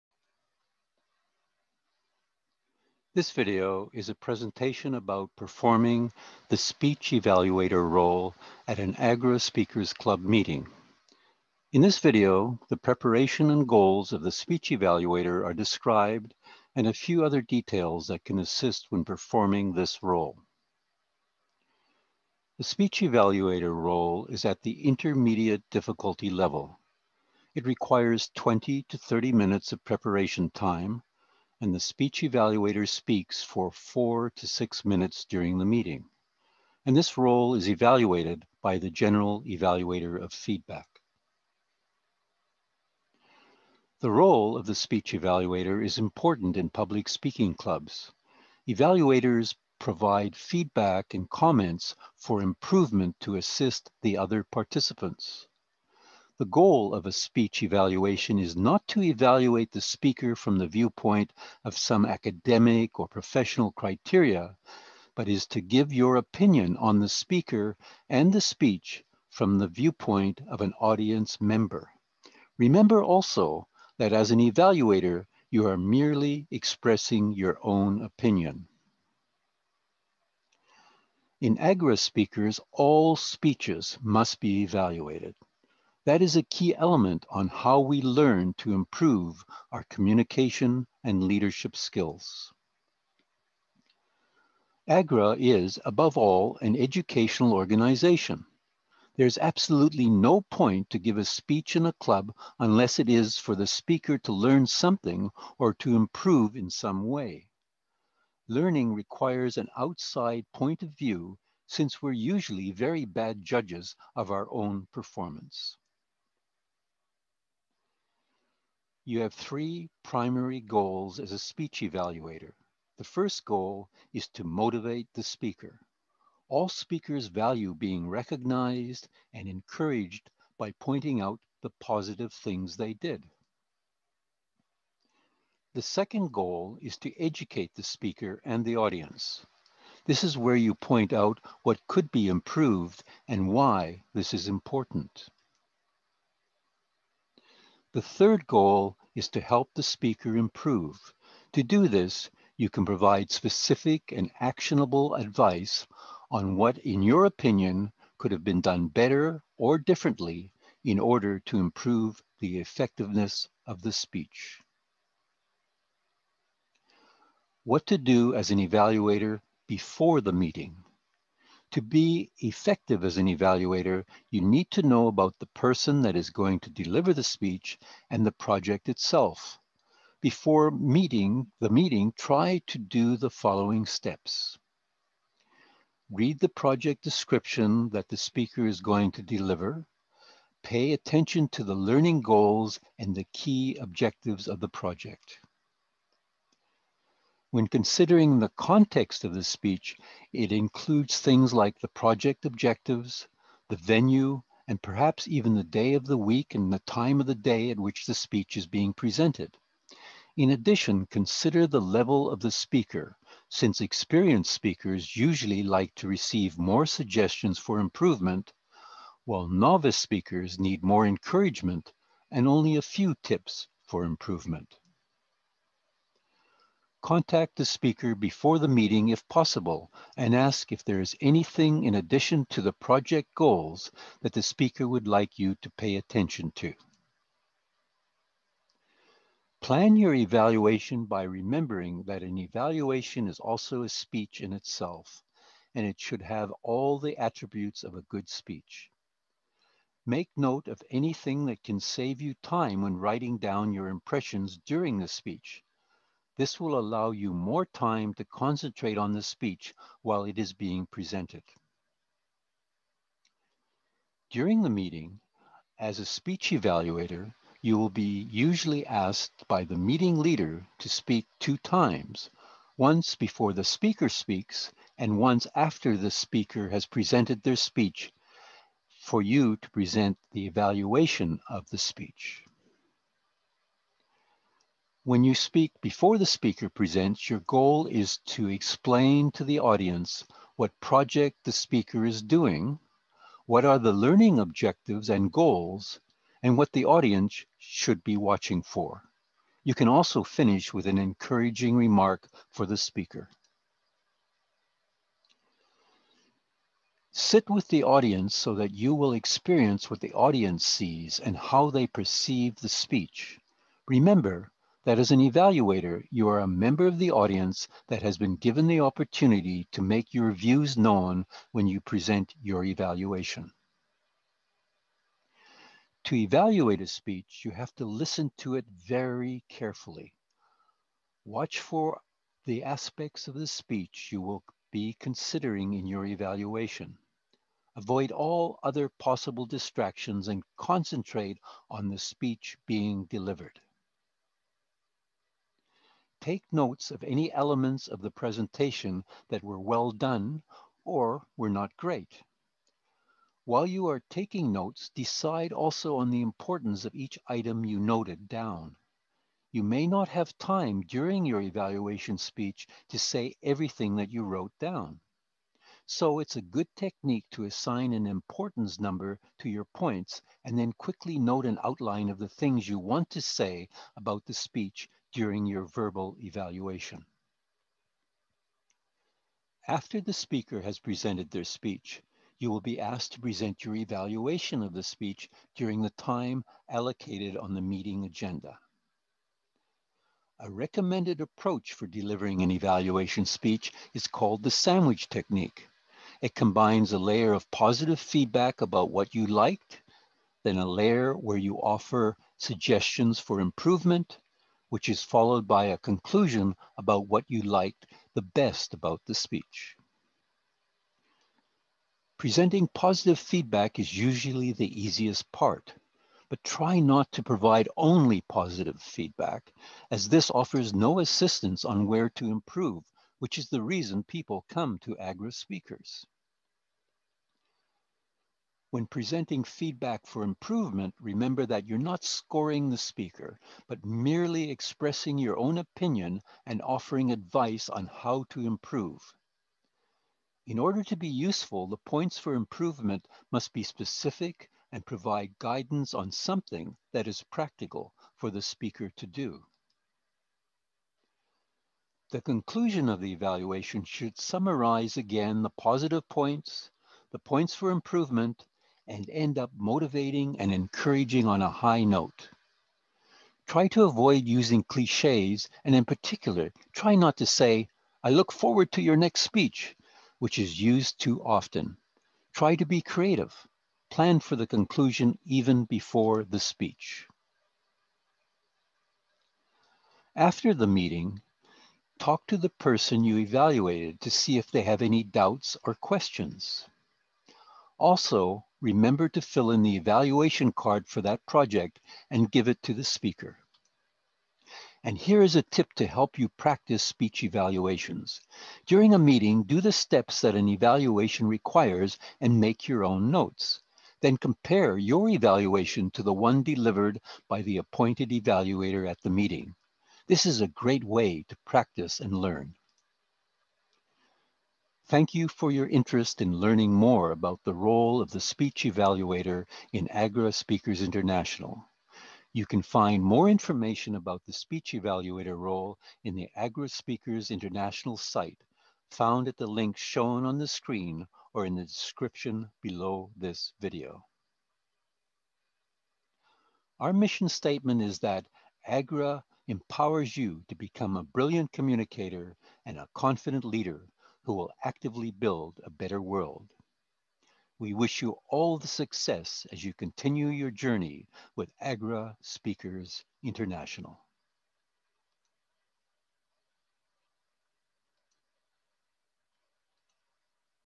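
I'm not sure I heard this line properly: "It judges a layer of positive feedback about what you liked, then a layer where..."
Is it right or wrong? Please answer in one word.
wrong.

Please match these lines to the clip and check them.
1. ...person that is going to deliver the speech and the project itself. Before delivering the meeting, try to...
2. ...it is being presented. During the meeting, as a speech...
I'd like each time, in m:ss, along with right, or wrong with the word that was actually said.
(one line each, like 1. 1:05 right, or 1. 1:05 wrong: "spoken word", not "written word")
1. 2:55 wrong: "meeting", not "delivering"
2. 4:20 right.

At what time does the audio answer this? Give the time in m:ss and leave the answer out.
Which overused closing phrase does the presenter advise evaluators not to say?
7:48.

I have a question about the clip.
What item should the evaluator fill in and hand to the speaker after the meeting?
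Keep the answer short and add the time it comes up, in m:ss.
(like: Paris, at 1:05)
evaluation card, at 8:09.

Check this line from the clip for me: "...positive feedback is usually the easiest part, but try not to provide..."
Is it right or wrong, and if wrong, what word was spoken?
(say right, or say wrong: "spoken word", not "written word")
right.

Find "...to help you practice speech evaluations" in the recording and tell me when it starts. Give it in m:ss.
8:15.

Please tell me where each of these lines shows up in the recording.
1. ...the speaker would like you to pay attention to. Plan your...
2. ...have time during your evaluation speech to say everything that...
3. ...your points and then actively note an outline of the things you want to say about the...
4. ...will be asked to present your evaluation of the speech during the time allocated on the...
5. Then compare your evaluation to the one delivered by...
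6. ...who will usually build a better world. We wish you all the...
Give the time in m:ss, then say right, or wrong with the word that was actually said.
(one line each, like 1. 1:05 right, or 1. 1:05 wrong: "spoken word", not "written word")
1. 3:54 right
2. 6:00 right
3. 6:09 wrong: "quickly", not "actively"
4. 6:22 right
5. 8:23 right
6. 9:04 wrong: "actively", not "usually".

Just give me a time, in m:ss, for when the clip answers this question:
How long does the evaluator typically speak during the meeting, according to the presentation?
0:33.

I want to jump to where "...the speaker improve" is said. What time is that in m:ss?
2:29.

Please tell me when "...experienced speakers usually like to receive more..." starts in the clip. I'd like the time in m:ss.
3:33.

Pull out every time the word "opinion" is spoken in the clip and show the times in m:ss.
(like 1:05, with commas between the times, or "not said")
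1:06, 1:18, 2:37, 7:15.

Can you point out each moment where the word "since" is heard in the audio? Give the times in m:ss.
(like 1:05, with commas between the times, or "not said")
1:51, 3:33.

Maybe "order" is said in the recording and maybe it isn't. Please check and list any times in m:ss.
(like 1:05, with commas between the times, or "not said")
2:41, 7:20.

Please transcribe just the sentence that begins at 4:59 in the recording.
You can also finish with an encouraging remark for the speaker.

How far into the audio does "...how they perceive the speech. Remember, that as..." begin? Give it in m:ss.
5:11.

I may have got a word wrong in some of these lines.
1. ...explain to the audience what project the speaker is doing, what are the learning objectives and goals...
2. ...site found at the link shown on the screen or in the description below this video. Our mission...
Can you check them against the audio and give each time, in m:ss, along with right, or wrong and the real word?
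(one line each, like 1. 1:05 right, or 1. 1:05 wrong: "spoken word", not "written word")
1. 4:48 right
2. 8:47 right.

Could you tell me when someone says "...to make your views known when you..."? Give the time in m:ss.
5:19.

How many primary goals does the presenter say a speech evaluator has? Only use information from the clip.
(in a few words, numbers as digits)
3.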